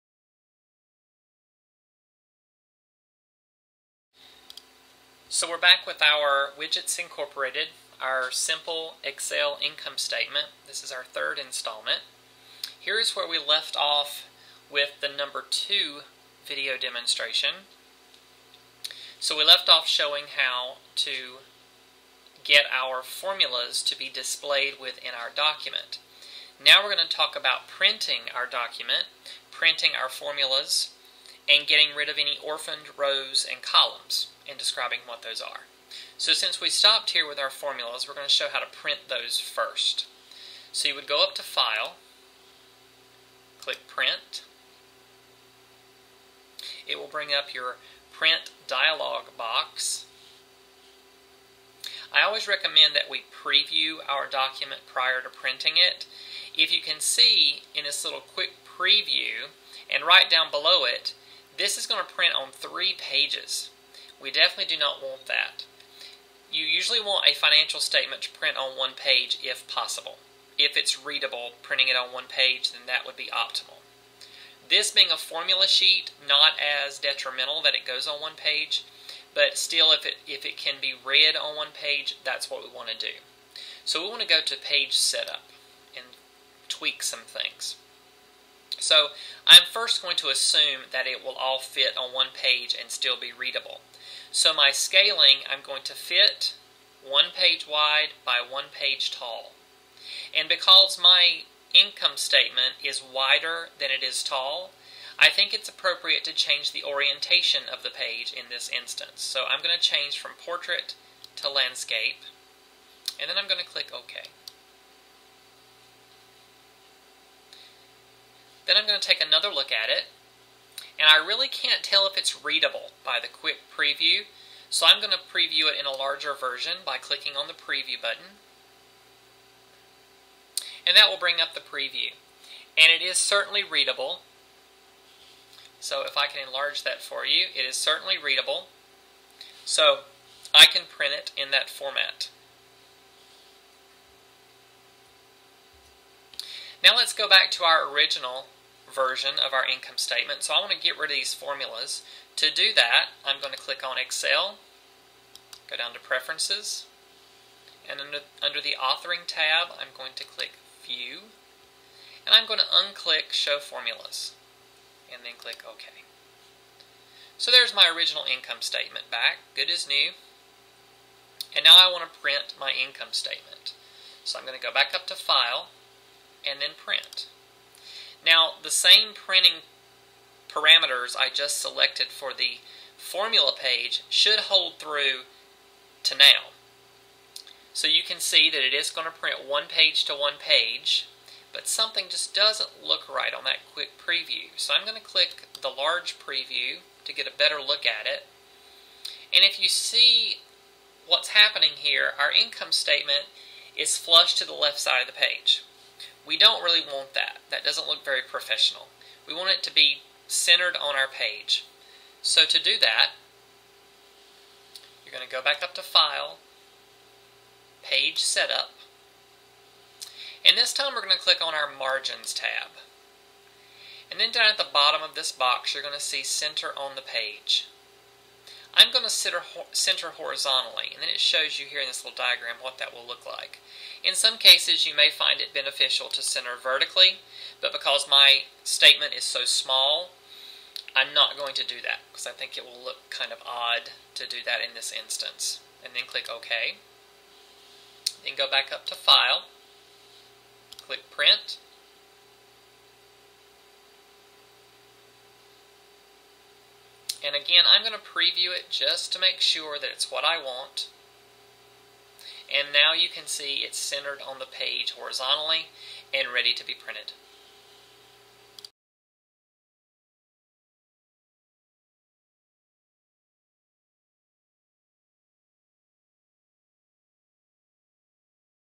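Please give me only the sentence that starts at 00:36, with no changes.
So since we stopped here with our formulas, we're going to show how to print those first.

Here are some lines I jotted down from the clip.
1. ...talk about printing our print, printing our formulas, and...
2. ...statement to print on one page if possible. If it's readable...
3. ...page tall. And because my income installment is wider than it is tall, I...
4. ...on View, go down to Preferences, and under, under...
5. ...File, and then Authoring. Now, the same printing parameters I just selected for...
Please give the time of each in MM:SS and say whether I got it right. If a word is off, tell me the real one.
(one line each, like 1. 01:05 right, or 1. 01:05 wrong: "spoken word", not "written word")
1. 00:27 wrong: "document", not "print"
2. 01:07 right
3. 01:38 wrong: "statement", not "installment"
4. 02:33 wrong: "Excel", not "View"
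5. 02:55 wrong: "Print", not "Authoring".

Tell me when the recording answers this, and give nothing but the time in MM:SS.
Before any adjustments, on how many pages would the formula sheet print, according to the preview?
01:02.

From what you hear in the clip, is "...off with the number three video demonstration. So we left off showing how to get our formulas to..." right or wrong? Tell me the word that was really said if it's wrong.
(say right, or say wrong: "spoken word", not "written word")
wrong: "two", not "three".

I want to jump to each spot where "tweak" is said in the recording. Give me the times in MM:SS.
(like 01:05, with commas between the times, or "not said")
01:26.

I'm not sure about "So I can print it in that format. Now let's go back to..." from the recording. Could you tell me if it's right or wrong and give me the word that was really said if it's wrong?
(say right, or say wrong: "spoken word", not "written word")
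right.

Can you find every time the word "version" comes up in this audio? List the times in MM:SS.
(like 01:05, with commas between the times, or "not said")
02:06, 02:28.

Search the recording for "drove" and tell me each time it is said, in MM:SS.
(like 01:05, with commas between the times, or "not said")
not said.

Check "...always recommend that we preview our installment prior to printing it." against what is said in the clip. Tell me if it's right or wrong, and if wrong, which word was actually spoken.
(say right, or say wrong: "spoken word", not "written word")
wrong: "document", not "installment".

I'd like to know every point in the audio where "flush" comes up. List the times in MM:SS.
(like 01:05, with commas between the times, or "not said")
03:23.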